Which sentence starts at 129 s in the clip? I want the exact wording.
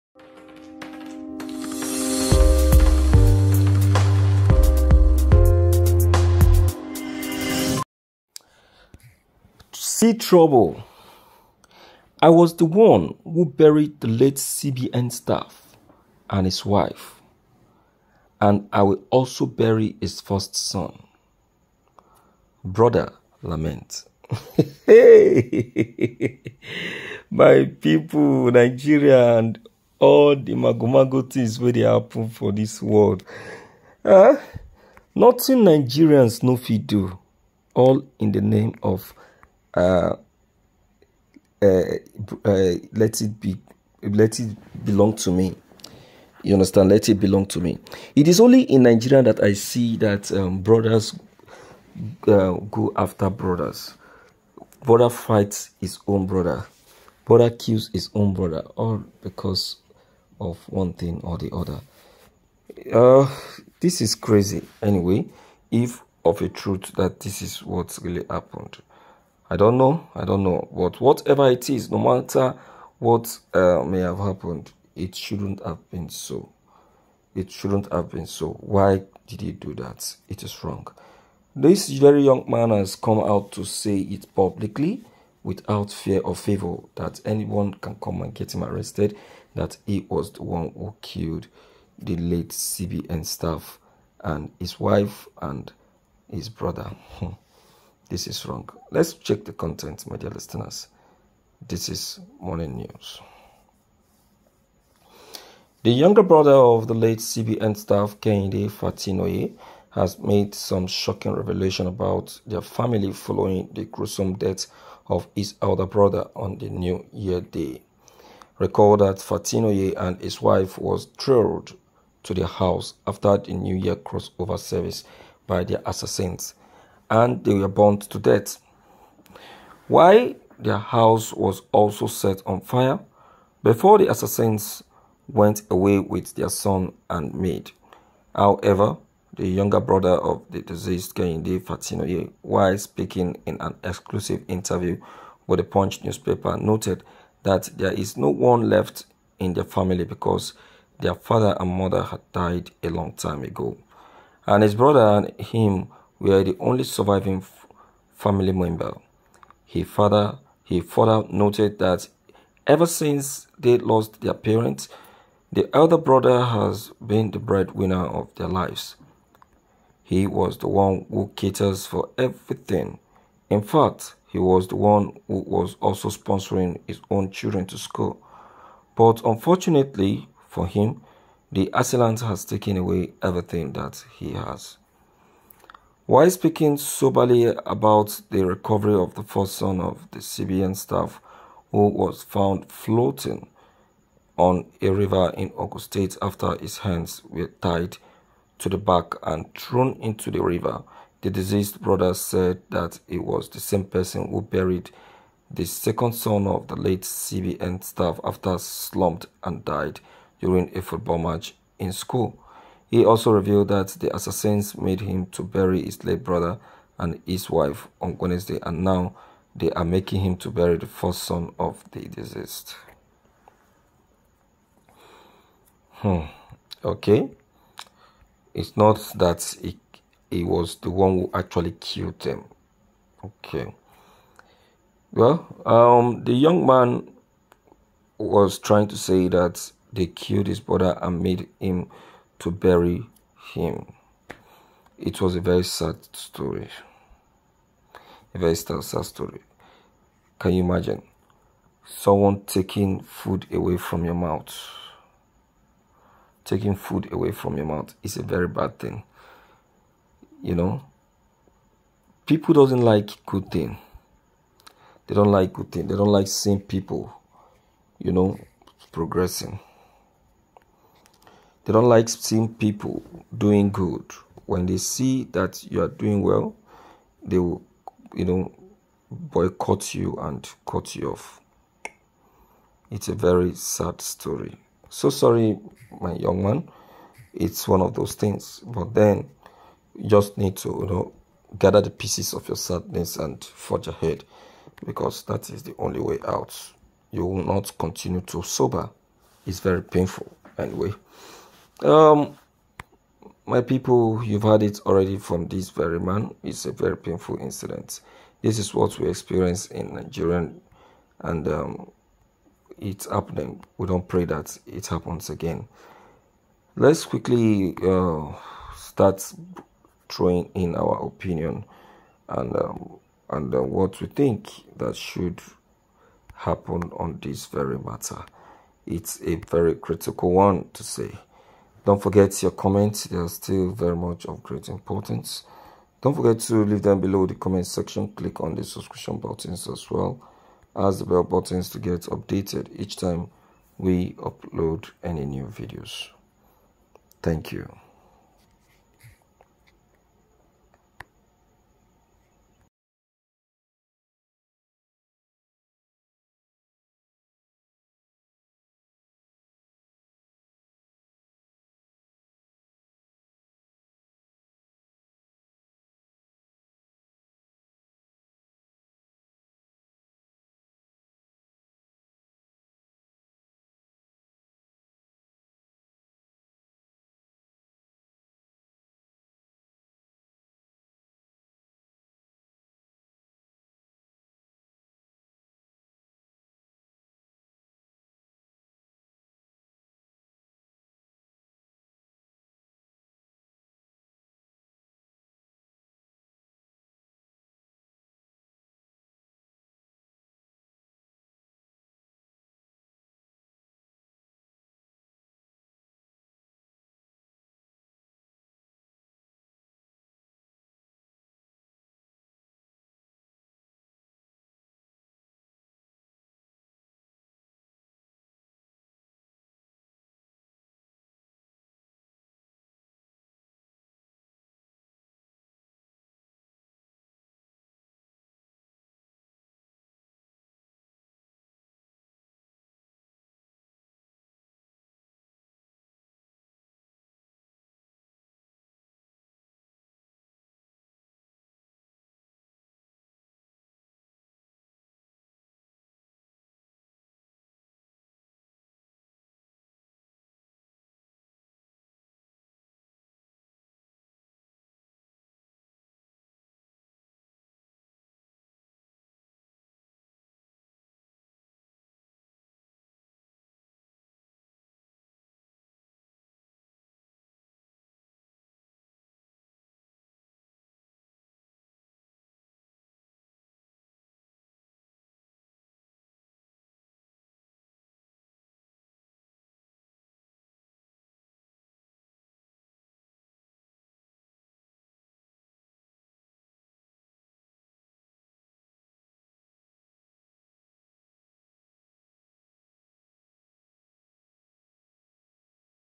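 While their house was also set on fire, before the assassins went away with their son and maid.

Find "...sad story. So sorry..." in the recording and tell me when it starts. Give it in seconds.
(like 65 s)
283 s.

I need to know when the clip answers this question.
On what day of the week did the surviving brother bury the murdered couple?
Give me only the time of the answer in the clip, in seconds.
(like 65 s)
218 s.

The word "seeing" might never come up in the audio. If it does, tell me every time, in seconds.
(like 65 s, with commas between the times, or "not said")
266 s, 272 s.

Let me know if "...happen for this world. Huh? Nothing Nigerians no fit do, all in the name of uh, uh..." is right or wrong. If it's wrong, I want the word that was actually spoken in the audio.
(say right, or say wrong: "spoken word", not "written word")
right.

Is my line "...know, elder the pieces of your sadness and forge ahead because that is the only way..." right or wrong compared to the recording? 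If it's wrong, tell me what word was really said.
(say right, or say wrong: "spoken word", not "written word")
wrong: "gather", not "elder".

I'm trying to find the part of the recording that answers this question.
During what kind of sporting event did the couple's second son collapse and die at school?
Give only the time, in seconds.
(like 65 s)
210 s.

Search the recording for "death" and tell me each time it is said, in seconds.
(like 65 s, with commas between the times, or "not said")
114 s, 128 s.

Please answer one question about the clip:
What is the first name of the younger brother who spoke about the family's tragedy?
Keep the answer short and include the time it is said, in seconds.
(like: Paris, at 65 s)
Kehinde, at 141 s.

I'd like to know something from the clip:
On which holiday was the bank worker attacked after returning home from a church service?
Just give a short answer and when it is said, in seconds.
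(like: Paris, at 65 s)
New Year day, at 116 s.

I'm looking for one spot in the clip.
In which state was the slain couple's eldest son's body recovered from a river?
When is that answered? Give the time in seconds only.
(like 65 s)
195 s.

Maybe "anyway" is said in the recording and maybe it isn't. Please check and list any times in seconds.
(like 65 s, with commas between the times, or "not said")
64 s, 300 s.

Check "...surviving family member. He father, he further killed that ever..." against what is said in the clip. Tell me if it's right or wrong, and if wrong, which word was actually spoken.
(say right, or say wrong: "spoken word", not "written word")
wrong: "noted", not "killed".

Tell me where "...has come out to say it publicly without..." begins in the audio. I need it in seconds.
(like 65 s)
82 s.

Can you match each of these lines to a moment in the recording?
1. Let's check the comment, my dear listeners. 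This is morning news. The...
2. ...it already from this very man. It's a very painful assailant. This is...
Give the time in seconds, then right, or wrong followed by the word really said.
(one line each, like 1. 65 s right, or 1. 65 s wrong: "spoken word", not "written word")
1. 98 s wrong: "content", not "comment"
2. 304 s wrong: "incident", not "assailant".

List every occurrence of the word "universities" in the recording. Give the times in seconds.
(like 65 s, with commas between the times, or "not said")
not said.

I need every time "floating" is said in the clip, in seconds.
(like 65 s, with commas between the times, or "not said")
192 s.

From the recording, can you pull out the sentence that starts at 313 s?
We don't pray that it happens again.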